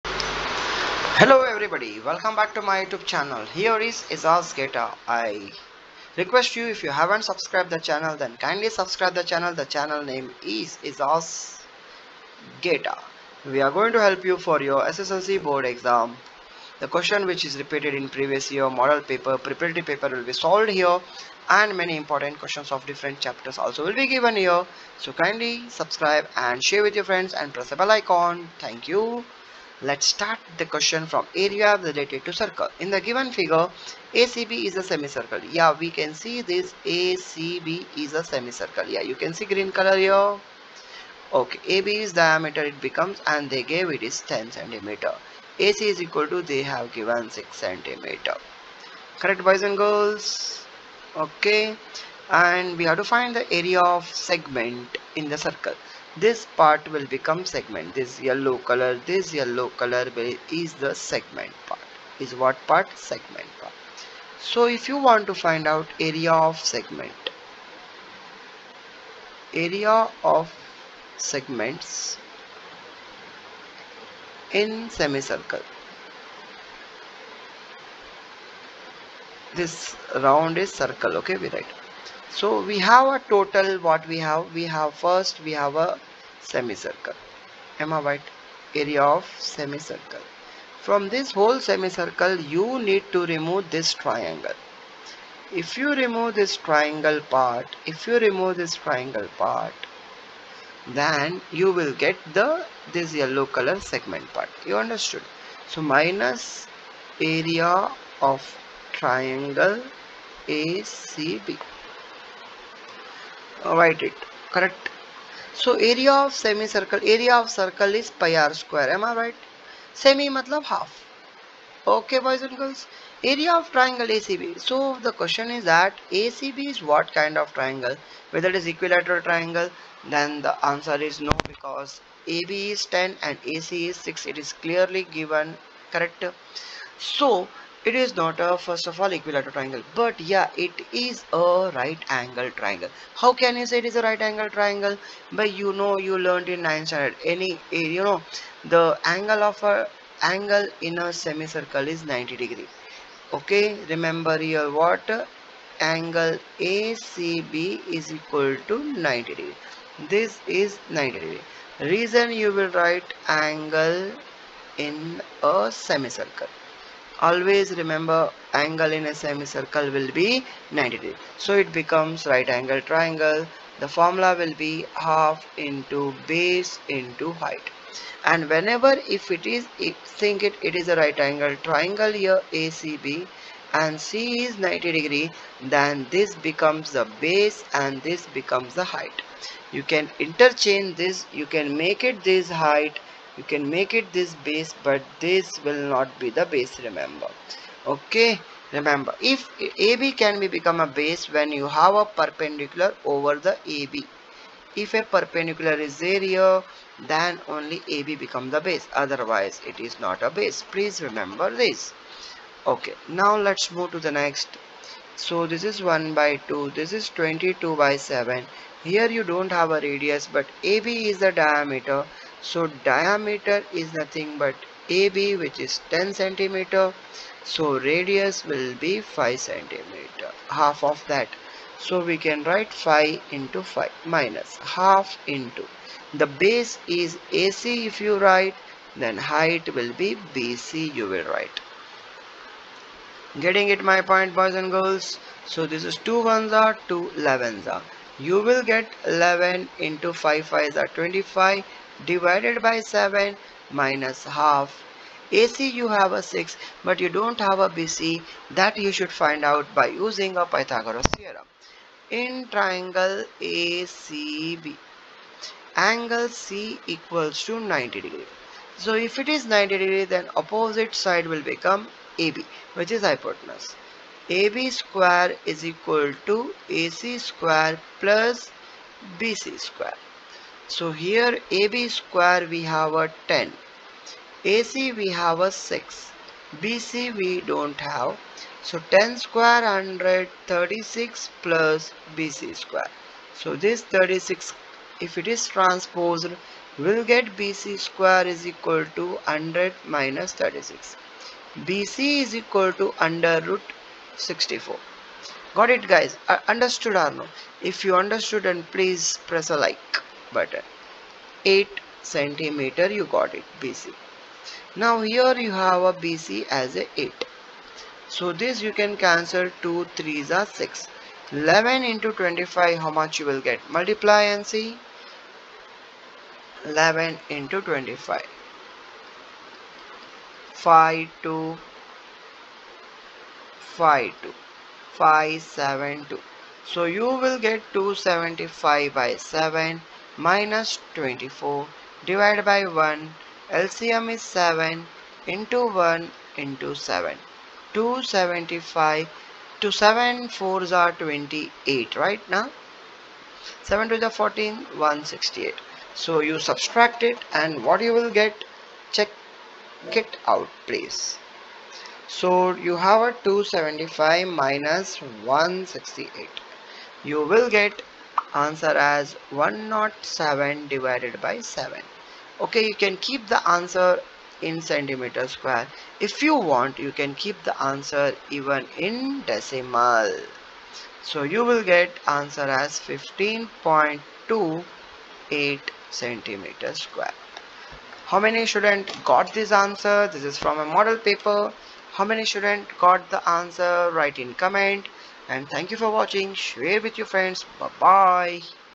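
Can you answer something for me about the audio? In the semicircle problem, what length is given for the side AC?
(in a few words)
6 centimeter.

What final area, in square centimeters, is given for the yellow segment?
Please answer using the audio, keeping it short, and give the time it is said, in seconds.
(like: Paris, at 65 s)
15.28, at 382 s.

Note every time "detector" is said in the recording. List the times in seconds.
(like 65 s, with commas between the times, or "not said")
not said.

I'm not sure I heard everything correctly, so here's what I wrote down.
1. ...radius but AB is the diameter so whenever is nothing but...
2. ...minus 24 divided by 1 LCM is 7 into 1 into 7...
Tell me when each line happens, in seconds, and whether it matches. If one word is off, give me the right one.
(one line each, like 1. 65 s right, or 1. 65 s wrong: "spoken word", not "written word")
1. 219 s wrong: "diameter", not "whenever"
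2. 340 s right.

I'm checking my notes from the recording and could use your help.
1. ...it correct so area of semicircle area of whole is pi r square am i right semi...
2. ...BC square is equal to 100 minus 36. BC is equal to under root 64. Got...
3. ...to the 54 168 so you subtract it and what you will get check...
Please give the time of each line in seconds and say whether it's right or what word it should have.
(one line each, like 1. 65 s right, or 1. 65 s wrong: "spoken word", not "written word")
1. 114 s wrong: "circle", not "whole"
2. 297 s right
3. 353 s wrong: "14", not "54".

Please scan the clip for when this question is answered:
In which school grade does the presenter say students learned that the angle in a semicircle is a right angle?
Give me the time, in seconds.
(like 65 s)
146 s.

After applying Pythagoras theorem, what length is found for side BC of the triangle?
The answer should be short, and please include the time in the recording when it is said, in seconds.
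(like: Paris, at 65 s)
8 centimeter, at 311 s.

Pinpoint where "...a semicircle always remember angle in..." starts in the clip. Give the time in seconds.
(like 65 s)
165 s.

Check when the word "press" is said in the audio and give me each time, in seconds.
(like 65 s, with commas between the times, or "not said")
27 s, 309 s.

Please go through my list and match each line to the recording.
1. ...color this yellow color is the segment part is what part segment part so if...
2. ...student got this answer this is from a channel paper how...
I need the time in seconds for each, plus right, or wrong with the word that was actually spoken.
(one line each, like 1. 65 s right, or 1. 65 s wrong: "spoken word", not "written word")
1. 58 s right
2. 388 s wrong: "model", not "channel".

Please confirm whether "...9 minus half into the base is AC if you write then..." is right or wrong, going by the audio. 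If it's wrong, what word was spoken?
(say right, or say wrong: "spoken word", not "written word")
wrong: "5", not "9".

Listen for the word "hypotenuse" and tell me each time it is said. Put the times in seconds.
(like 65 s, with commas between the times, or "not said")
273 s.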